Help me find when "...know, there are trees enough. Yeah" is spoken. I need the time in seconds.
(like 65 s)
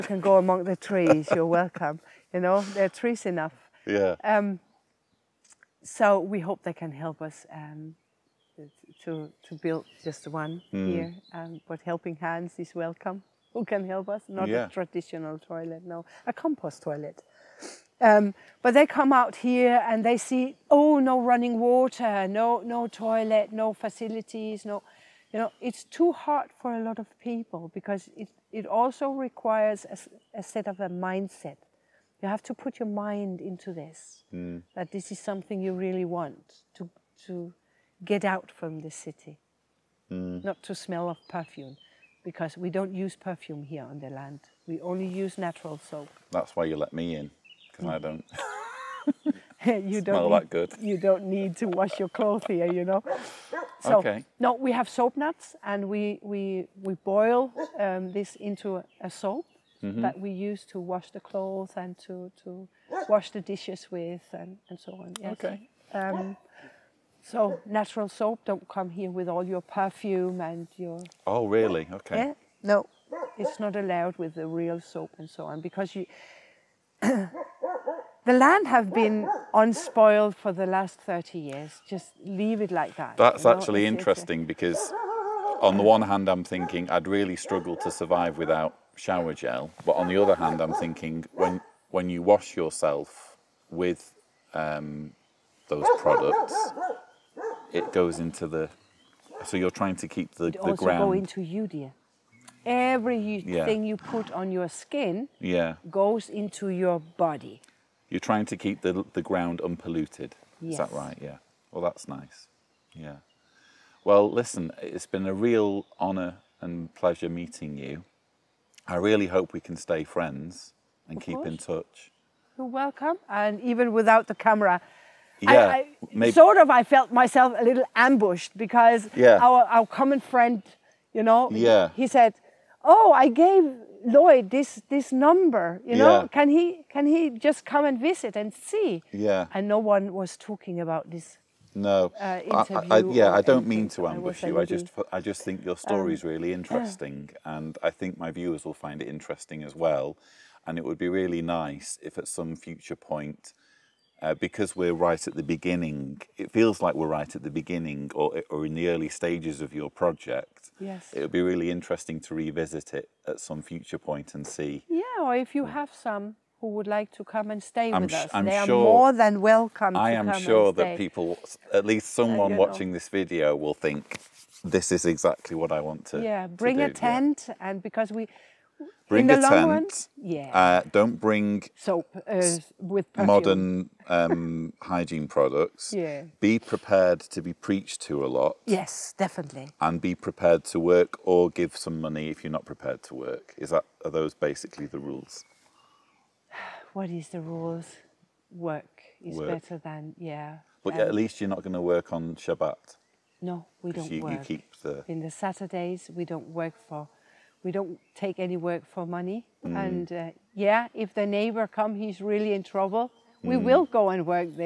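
2 s.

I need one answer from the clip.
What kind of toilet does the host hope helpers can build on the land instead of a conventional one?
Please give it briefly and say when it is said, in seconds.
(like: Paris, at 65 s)
compost toilet, at 16 s.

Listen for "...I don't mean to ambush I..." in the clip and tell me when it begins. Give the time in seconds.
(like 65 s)
143 s.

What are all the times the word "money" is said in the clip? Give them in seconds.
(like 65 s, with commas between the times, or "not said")
192 s, 209 s.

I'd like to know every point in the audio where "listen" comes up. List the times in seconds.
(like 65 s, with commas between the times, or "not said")
114 s.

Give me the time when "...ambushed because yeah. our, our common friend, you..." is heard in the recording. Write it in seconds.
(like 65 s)
127 s.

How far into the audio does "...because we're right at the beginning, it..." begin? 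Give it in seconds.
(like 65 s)
154 s.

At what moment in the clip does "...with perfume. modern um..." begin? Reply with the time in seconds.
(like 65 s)
182 s.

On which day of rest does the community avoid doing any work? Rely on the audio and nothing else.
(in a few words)
Shabbat.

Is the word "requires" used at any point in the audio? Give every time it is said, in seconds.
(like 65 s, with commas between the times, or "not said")
29 s.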